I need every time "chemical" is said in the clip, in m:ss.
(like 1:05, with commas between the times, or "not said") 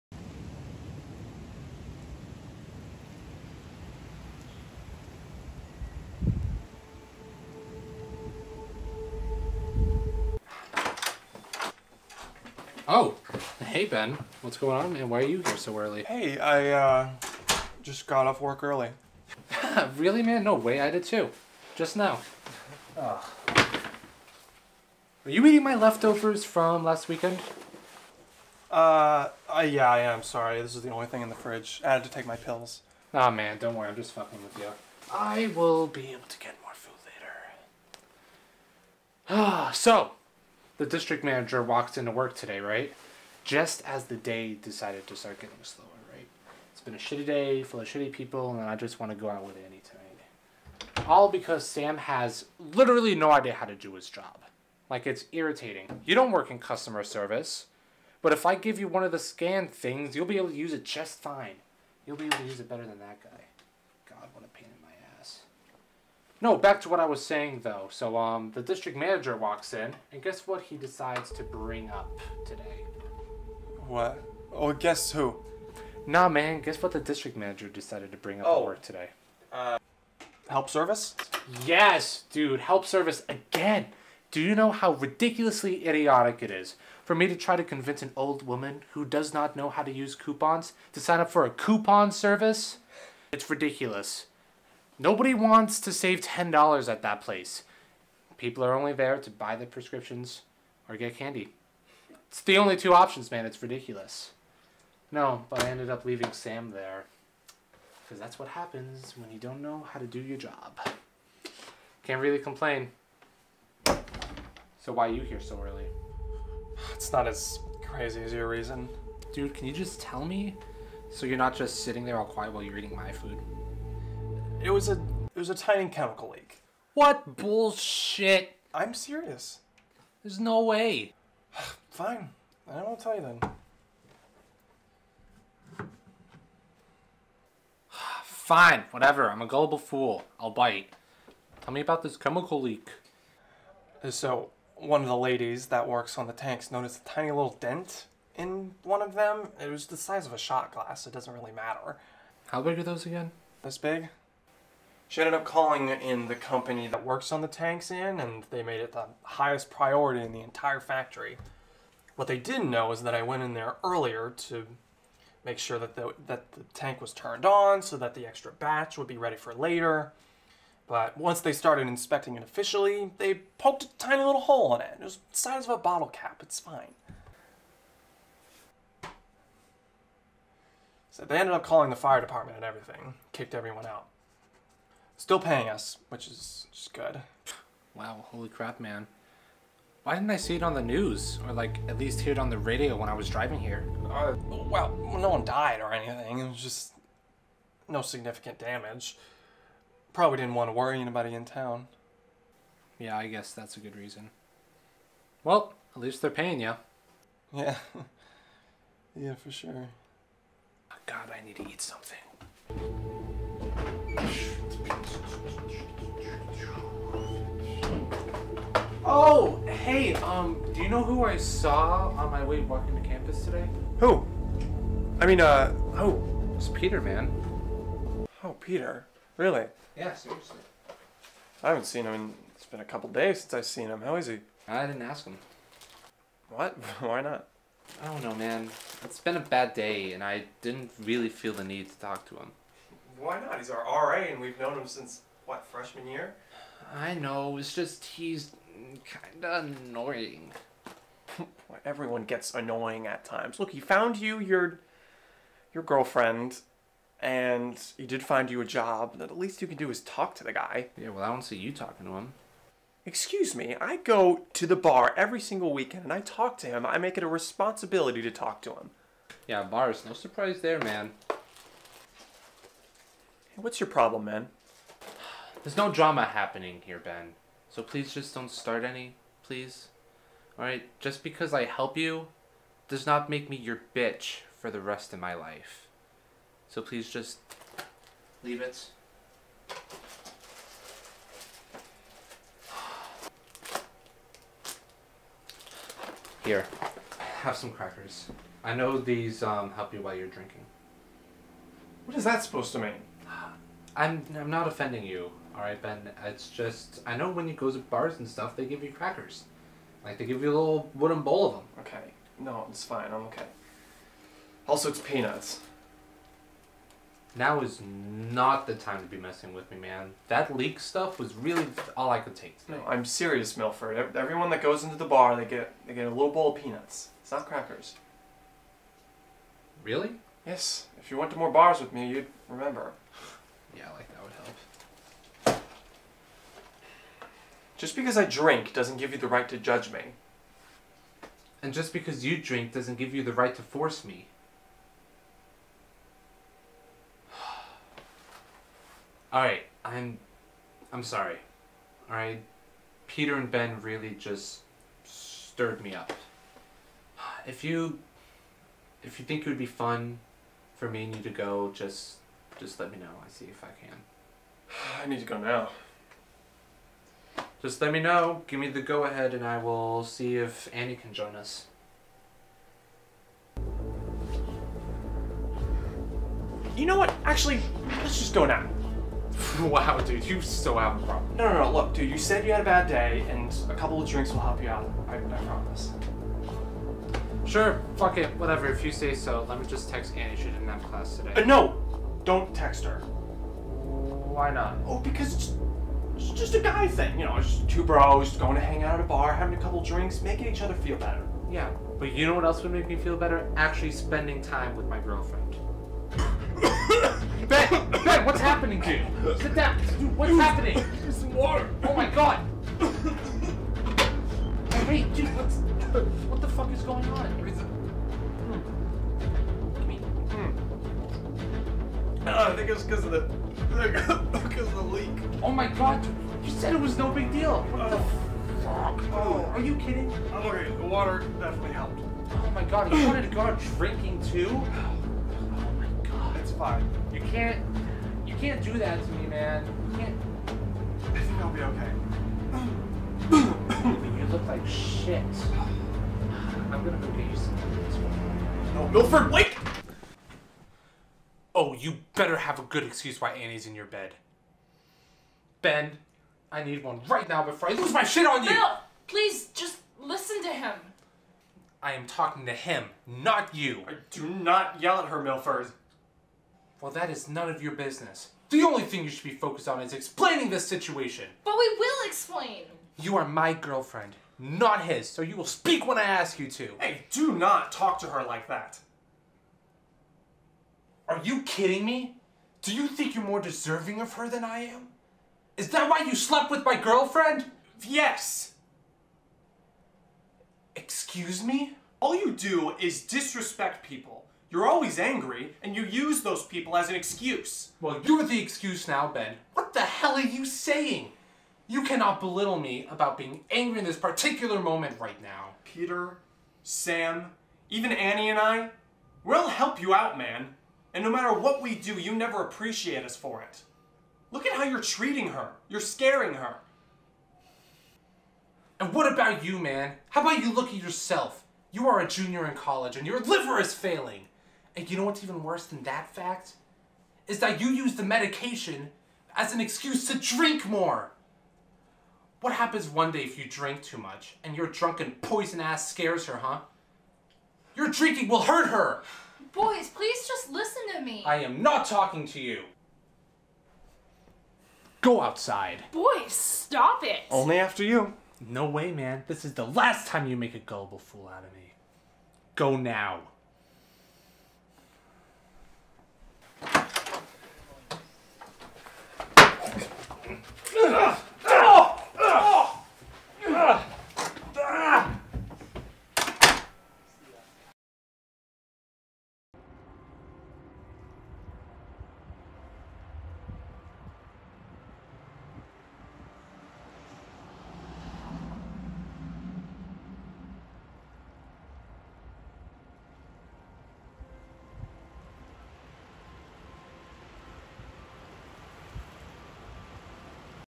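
2:05, 2:22.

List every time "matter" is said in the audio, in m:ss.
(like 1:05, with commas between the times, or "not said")
2:31, 8:31.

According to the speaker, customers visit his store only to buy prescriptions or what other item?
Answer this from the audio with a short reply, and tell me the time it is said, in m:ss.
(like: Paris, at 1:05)
Candy, at 1:41.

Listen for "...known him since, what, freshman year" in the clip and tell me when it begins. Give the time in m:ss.
4:04.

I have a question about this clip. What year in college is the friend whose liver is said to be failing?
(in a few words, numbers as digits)
Junior.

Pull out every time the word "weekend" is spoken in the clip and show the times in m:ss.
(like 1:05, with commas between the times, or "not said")
0:27, 4:25.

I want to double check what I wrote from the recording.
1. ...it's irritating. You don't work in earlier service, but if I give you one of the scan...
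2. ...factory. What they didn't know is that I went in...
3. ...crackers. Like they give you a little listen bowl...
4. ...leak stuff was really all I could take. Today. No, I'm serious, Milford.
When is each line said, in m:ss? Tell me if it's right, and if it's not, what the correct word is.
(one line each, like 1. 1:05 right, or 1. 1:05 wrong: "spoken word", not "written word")
1. 0:55 wrong: "customer", not "earlier"
2. 2:40 right
3. 5:08 wrong: "wooden", not "listen"
4. 5:20 right.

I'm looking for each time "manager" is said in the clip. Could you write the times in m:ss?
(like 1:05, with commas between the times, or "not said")
0:41, 1:08, 1:17.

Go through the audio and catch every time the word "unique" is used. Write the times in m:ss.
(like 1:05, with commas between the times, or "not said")
not said.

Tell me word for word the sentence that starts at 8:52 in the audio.
What happens one day if you drink too much and your drunken poison ass scares her, huh?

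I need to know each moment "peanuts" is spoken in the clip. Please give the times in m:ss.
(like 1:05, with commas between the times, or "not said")
5:15, 5:26.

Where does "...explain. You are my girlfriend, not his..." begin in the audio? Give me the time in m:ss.
7:52.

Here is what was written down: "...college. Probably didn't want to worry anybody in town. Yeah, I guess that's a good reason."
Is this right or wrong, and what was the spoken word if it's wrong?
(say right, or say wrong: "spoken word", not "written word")
wrong: "damage", not "college".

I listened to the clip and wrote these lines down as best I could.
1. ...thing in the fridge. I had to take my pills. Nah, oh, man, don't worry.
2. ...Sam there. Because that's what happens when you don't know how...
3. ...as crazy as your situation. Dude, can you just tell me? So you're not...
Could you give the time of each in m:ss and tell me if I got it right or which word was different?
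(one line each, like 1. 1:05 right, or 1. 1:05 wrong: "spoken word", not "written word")
1. 0:31 right
2. 1:46 right
3. 1:57 wrong: "reason", not "situation".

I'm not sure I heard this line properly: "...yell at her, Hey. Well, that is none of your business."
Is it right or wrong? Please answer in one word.
wrong.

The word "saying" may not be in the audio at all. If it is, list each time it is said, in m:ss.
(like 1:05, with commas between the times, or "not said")
1:07, 8:20.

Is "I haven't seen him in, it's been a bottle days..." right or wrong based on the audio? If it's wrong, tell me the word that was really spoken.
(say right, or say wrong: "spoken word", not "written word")
wrong: "couple", not "bottle".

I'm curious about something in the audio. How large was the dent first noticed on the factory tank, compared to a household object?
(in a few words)
A shot glass.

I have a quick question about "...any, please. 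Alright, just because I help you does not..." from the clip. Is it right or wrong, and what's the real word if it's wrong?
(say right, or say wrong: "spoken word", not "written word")
right.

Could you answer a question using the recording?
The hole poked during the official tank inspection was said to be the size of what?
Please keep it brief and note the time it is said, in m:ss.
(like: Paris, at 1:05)
A bottle cap, at 2:55.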